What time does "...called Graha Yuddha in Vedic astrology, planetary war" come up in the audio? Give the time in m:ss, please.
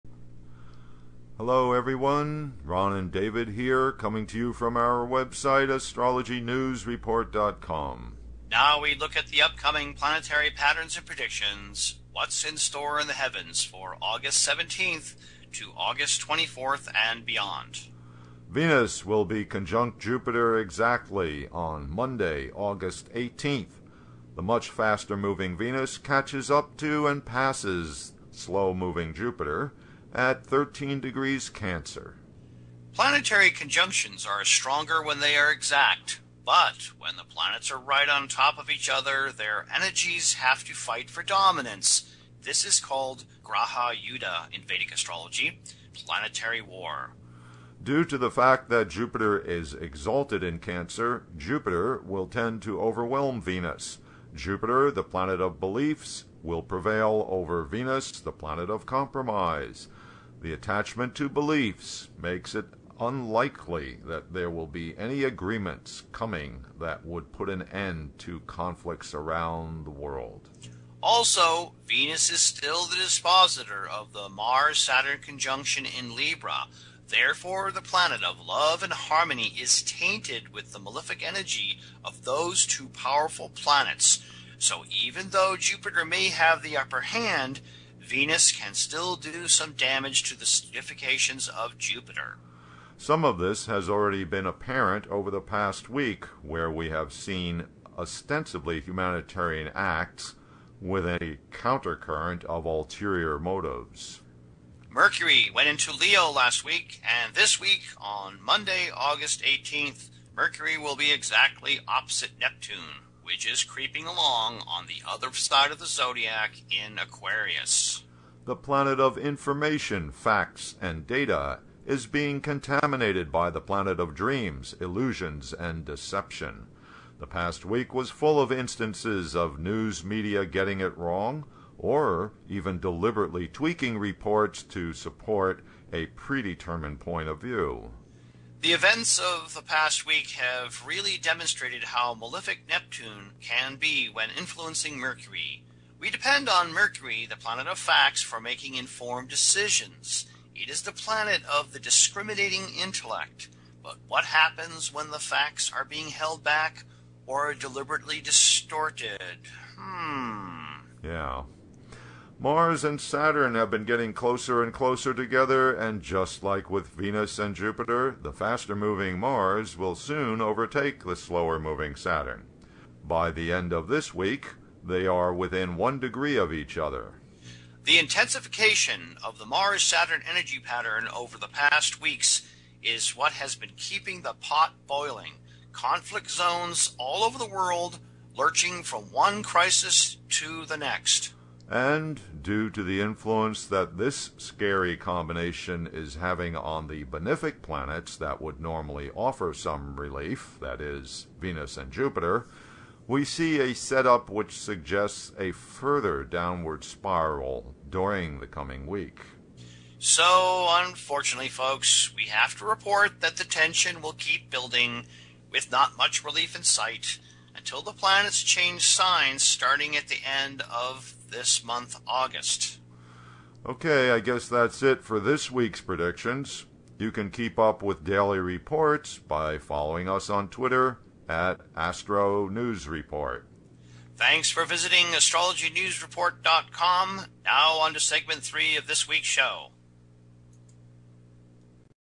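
0:42.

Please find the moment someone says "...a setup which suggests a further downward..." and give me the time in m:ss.
3:23.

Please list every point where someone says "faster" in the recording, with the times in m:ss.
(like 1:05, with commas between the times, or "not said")
0:24, 2:48.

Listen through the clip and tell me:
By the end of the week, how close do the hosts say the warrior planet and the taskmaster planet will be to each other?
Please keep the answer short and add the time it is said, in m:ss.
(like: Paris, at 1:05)
1 degree, at 2:55.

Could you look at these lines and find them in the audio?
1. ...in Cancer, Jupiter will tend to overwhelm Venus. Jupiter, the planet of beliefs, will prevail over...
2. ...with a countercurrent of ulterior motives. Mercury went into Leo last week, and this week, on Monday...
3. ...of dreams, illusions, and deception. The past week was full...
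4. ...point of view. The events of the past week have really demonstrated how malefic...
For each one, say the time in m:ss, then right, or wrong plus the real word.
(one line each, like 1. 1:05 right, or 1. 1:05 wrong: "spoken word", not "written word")
1. 0:50 right
2. 1:40 right
3. 2:03 right
4. 2:16 right.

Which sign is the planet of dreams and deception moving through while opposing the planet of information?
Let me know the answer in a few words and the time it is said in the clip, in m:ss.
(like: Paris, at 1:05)
Aquarius, at 1:56.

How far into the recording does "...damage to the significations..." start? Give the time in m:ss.
1:29.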